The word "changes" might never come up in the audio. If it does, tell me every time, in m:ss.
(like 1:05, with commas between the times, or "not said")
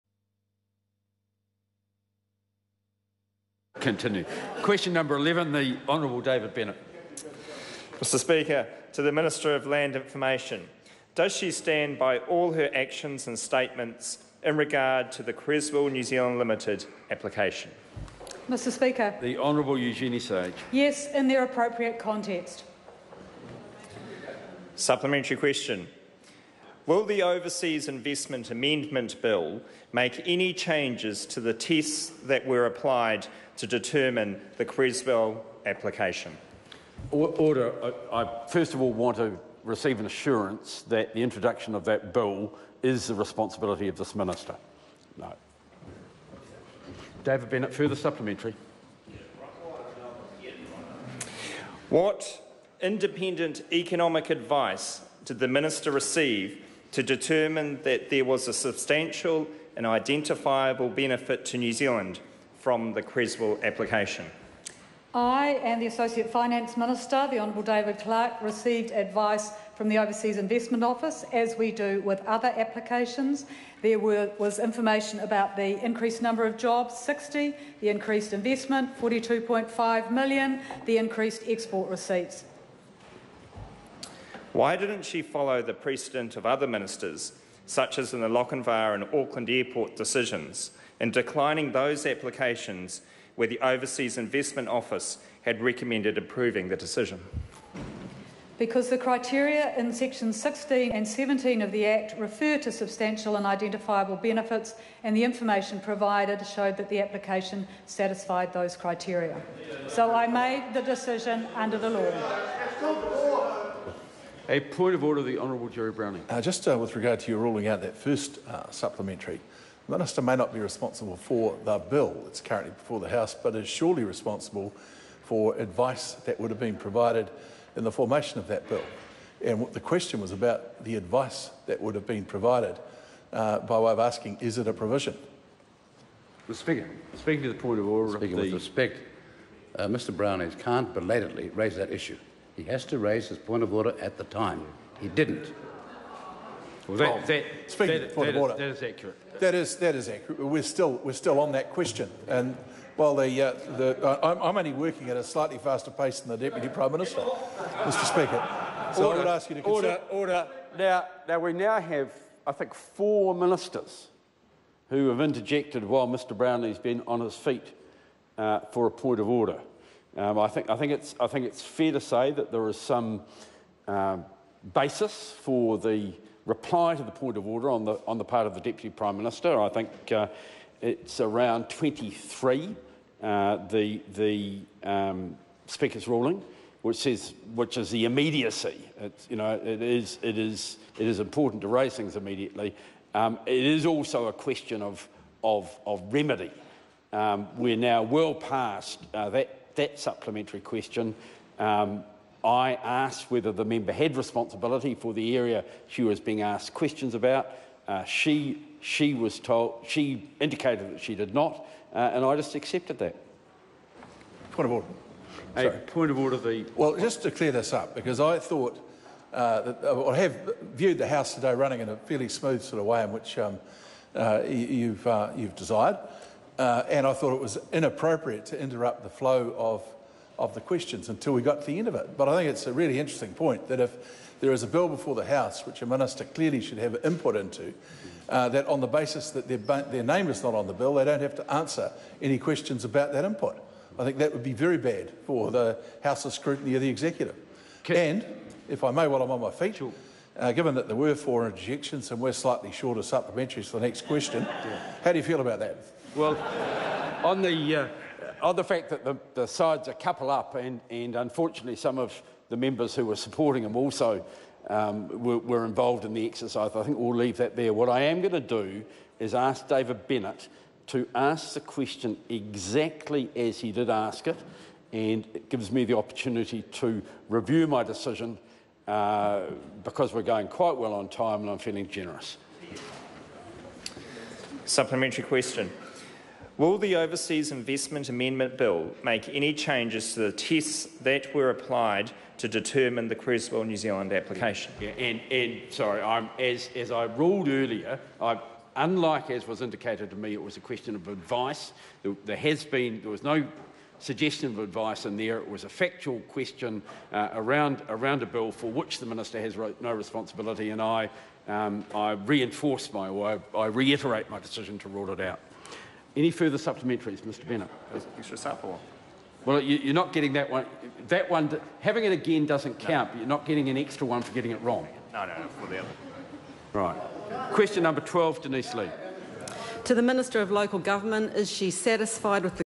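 0:30, 4:49.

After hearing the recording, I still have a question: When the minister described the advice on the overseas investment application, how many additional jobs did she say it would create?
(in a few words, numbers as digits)
60.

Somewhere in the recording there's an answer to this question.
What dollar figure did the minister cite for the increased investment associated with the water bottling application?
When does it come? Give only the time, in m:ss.
1:19.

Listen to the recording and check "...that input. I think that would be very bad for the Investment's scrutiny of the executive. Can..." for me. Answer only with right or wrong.
wrong.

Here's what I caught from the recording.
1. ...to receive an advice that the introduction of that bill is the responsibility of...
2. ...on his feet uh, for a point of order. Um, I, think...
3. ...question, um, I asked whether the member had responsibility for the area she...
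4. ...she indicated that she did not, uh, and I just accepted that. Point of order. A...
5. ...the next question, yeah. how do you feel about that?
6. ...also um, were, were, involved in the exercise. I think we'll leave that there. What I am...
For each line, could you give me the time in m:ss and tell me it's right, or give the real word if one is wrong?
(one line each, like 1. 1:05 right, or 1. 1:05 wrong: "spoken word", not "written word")
1. 0:39 wrong: "assurance", not "advice"
2. 2:47 right
3. 3:20 right
4. 3:29 right
5. 4:13 right
6. 4:23 right.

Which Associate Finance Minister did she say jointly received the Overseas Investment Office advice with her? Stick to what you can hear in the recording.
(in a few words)
David Clark.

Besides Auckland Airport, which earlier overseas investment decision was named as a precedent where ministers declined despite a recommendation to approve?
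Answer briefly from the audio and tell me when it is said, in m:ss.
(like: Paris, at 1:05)
Lochinvar, at 1:28.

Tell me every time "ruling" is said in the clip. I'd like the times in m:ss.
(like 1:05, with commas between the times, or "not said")
1:57, 3:06.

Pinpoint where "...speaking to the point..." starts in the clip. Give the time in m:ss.
2:17.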